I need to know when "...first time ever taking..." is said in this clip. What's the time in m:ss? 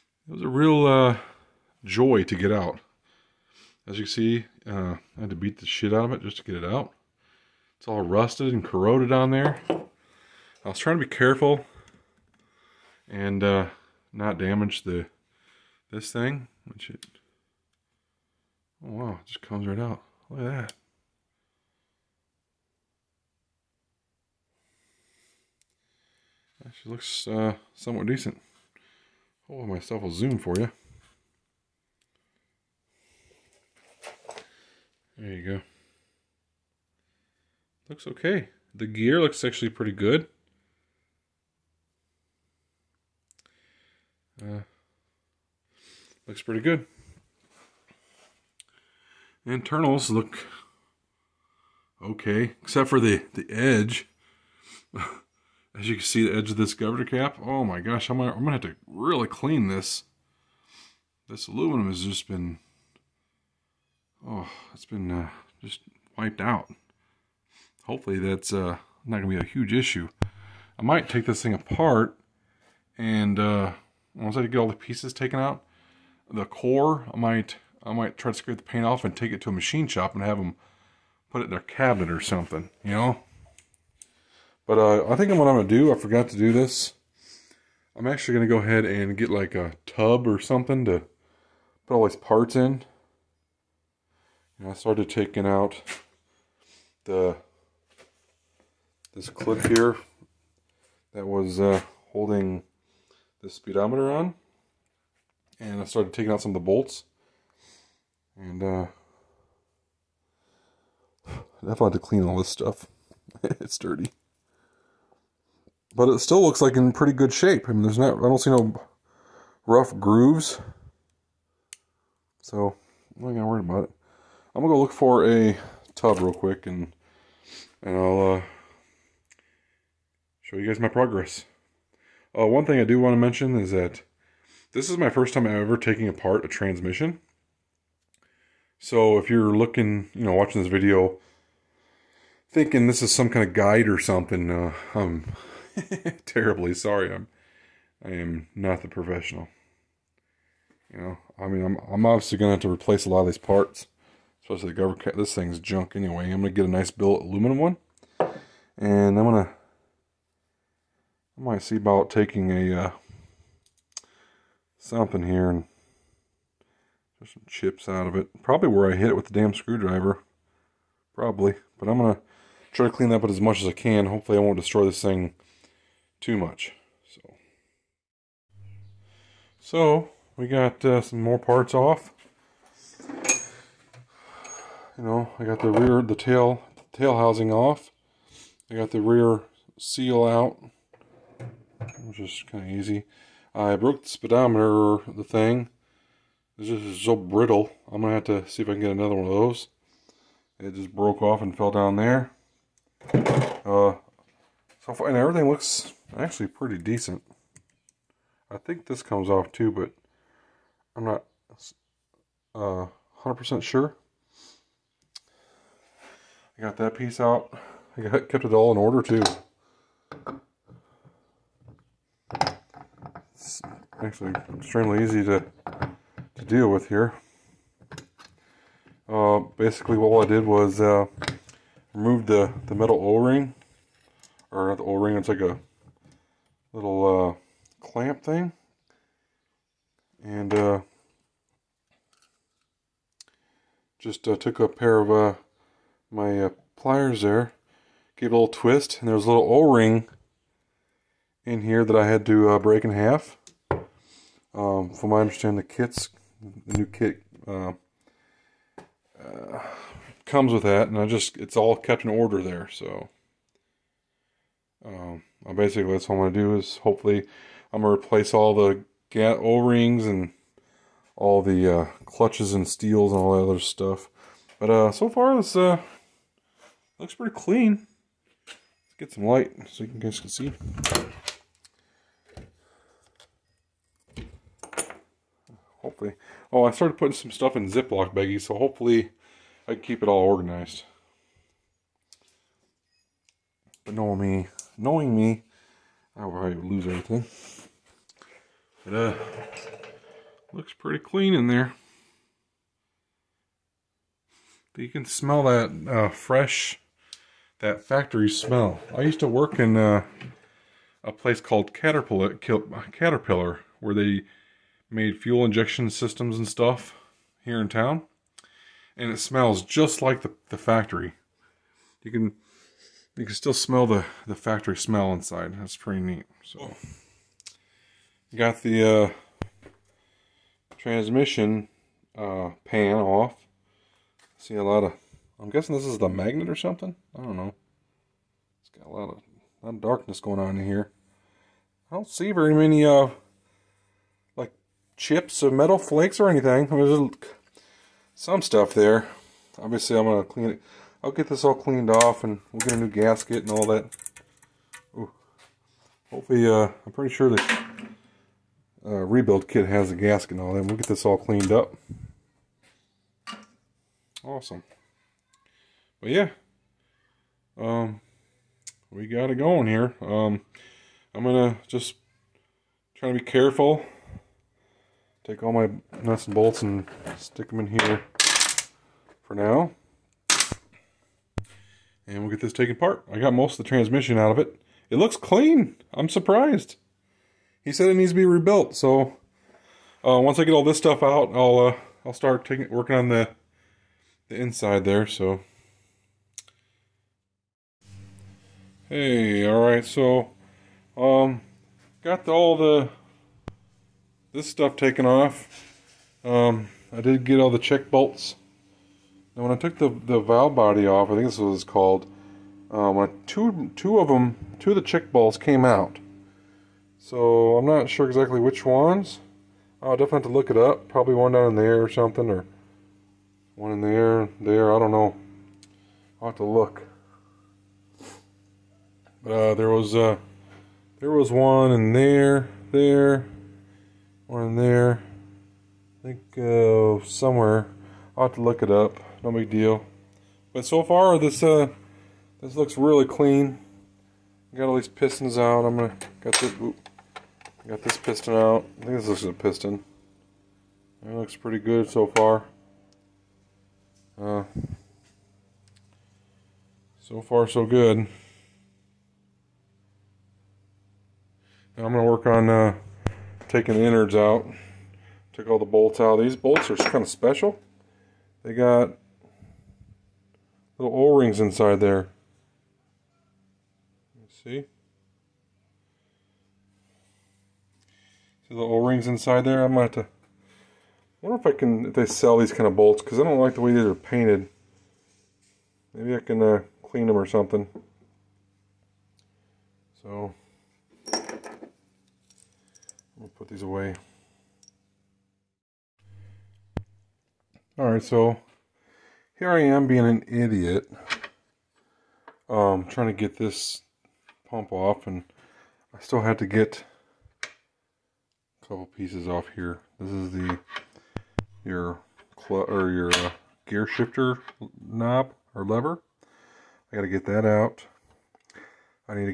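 2:15.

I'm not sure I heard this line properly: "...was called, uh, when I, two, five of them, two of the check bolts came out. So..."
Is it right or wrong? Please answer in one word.
wrong.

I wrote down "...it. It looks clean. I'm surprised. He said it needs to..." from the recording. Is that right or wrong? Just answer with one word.
right.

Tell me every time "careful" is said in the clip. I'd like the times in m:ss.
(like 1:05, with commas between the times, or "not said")
0:11, 6:13.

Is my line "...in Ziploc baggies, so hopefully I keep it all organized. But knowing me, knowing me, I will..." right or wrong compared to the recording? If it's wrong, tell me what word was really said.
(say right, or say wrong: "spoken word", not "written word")
right.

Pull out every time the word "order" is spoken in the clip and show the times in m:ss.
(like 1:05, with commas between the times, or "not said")
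3:38, 4:22.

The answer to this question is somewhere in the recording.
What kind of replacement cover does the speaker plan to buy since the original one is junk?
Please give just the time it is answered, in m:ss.
2:36.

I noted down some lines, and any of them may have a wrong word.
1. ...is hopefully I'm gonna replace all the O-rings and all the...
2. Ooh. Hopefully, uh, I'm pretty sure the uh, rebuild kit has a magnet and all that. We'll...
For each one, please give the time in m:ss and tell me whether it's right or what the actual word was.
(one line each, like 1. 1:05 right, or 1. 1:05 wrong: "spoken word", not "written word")
1. 4:26 right
2. 5:54 wrong: "gasket", not "magnet".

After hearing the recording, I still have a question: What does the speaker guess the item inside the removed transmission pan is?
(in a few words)
The magnet.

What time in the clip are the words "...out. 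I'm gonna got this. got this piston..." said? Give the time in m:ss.
7:25.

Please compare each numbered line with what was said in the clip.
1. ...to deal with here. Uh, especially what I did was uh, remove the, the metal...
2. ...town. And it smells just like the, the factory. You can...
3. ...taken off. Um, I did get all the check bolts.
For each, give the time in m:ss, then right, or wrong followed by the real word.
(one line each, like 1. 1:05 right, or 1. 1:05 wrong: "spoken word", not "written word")
1. 3:46 wrong: "basically", not "especially"
2. 5:17 right
3. 6:44 right.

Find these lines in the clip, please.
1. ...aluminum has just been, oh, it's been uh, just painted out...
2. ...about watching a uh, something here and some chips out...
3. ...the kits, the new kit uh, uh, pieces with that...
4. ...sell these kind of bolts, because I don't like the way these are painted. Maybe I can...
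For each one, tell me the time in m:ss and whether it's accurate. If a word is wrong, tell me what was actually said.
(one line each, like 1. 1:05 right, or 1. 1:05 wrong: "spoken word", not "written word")
1. 1:01 wrong: "wiped", not "painted"
2. 2:41 wrong: "taking", not "watching"
3. 4:15 wrong: "comes", not "pieces"
4. 8:02 right.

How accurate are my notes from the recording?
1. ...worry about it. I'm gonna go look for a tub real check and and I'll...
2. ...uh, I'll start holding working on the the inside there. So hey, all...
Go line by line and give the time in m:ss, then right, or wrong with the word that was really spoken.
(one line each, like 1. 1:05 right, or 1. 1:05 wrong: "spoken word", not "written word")
1. 2:03 wrong: "quick", not "check"
2. 6:31 wrong: "taking", not "holding".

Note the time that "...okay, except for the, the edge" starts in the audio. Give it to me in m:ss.
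0:52.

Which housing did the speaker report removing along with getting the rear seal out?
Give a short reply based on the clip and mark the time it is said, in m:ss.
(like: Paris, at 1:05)
Tail housing, at 3:06.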